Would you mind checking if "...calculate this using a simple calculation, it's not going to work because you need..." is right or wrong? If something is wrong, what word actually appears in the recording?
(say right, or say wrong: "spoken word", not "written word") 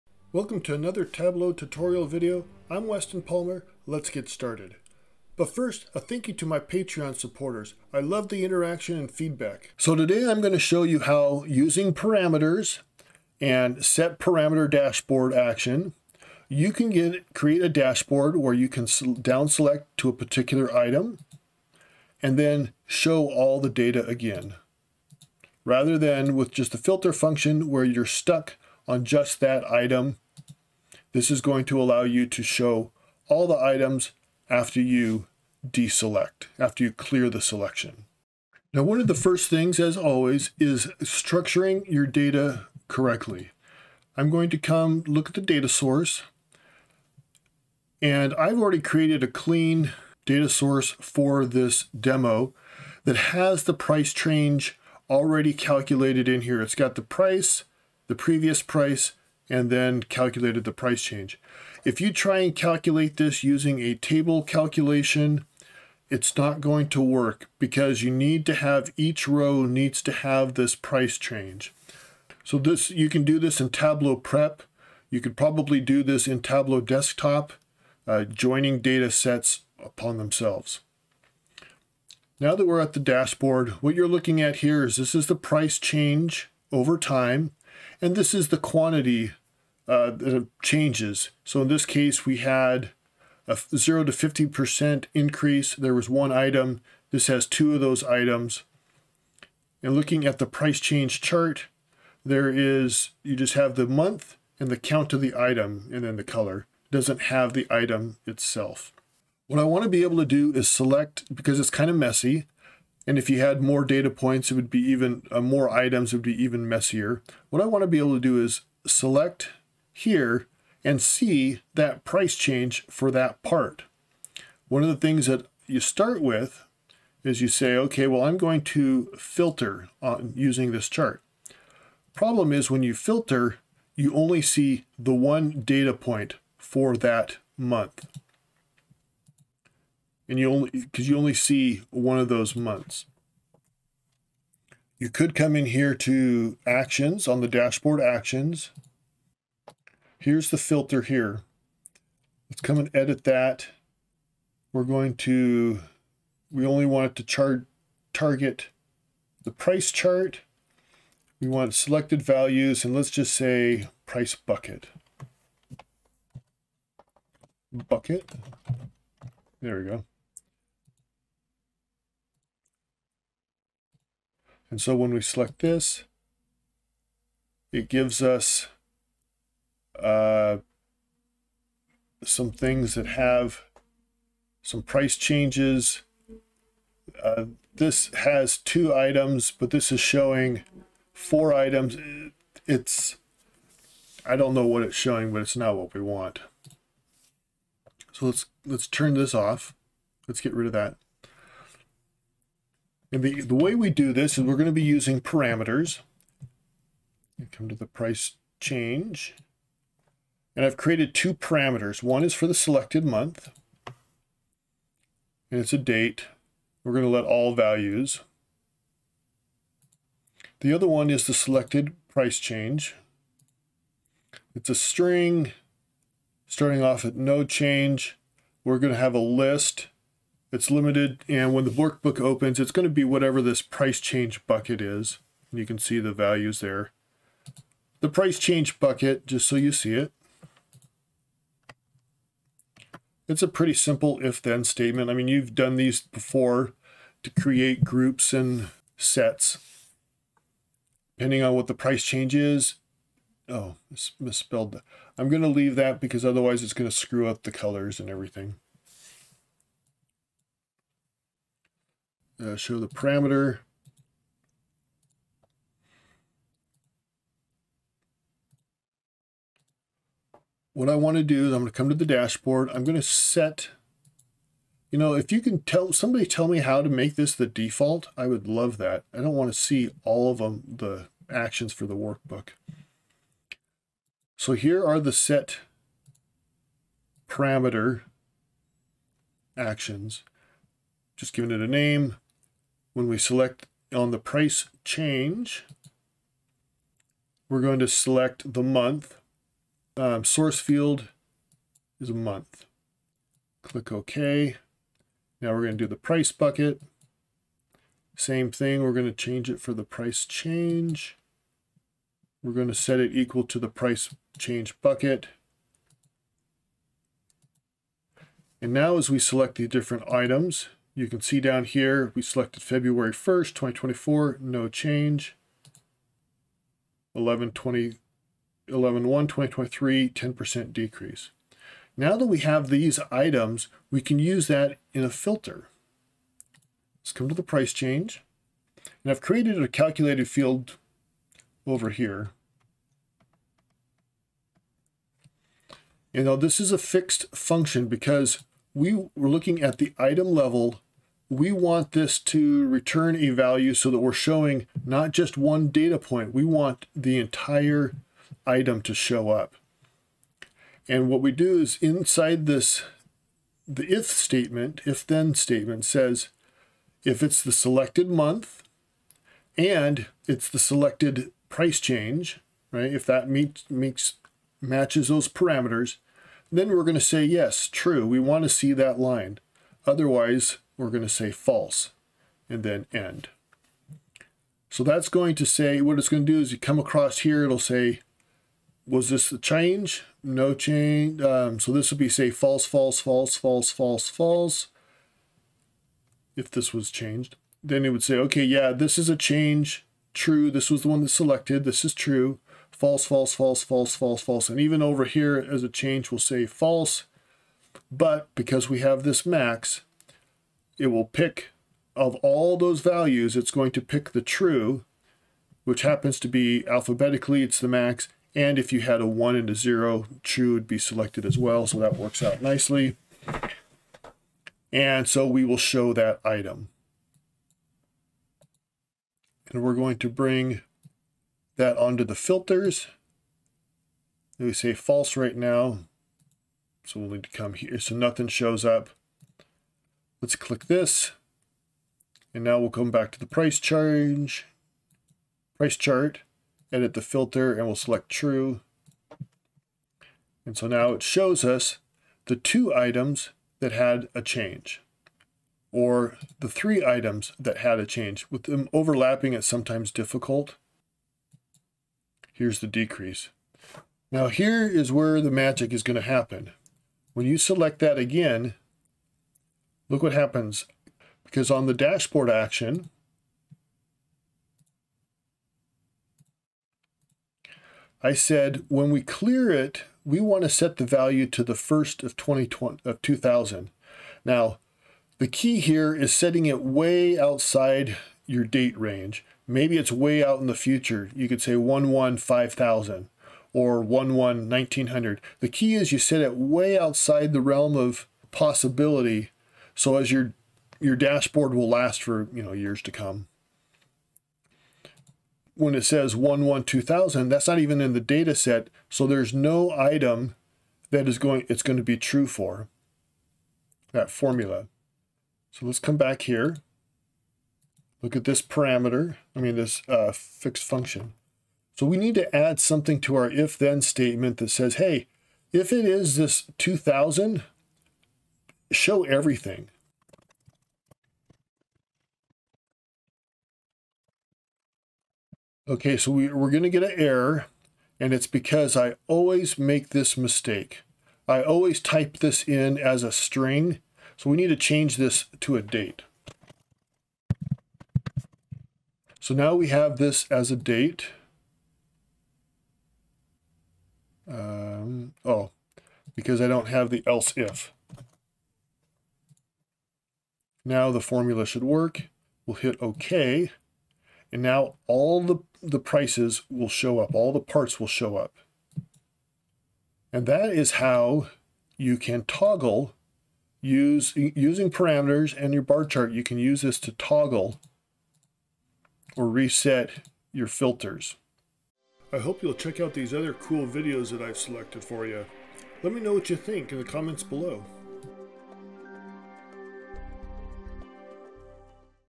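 wrong: "table", not "simple".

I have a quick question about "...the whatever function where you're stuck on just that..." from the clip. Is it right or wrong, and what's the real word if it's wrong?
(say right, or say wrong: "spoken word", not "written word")
wrong: "filter", not "whatever".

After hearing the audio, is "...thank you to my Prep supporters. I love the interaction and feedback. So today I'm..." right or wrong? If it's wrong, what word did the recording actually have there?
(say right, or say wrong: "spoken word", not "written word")
wrong: "Patreon", not "Prep".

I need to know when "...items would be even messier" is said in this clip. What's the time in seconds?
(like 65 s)
115 s.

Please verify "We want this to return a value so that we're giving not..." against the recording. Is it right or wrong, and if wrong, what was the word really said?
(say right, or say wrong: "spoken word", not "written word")
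wrong: "showing", not "giving".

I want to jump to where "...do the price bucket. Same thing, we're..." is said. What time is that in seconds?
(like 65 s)
305 s.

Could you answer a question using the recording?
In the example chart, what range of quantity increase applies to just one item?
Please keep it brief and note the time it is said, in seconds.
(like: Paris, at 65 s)
0 to 50%, at 93 s.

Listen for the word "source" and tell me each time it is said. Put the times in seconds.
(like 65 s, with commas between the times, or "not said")
45 s, 50 s, 300 s.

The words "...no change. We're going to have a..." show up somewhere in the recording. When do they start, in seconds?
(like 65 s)
227 s.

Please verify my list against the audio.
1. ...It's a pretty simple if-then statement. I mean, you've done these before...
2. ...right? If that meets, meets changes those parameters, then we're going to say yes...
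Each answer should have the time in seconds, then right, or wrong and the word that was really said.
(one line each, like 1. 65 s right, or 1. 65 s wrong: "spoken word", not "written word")
1. 243 s right
2. 372 s wrong: "matches", not "changes".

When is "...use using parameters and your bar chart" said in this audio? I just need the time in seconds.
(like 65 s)
573 s.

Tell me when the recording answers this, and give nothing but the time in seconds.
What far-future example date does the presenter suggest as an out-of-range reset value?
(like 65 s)
491 s.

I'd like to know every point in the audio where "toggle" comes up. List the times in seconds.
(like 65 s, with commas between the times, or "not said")
572 s, 576 s.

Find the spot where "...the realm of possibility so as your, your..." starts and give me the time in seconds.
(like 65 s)
497 s.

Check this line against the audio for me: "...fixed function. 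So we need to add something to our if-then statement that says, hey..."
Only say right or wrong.
right.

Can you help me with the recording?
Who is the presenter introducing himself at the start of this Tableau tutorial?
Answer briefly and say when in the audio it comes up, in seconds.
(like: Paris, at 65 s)
Weston Palmer, at 2 s.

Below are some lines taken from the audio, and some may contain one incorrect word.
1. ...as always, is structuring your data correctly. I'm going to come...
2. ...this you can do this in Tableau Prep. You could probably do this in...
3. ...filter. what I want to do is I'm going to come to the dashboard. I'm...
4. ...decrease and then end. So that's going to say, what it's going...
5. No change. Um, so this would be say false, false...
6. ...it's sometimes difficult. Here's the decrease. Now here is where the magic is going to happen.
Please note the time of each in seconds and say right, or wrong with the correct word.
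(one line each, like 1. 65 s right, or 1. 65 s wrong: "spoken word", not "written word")
1. 39 s right
2. 72 s right
3. 262 s wrong: "parameter", not "filter"
4. 381 s wrong: "false", not "decrease"
5. 390 s right
6. 459 s right.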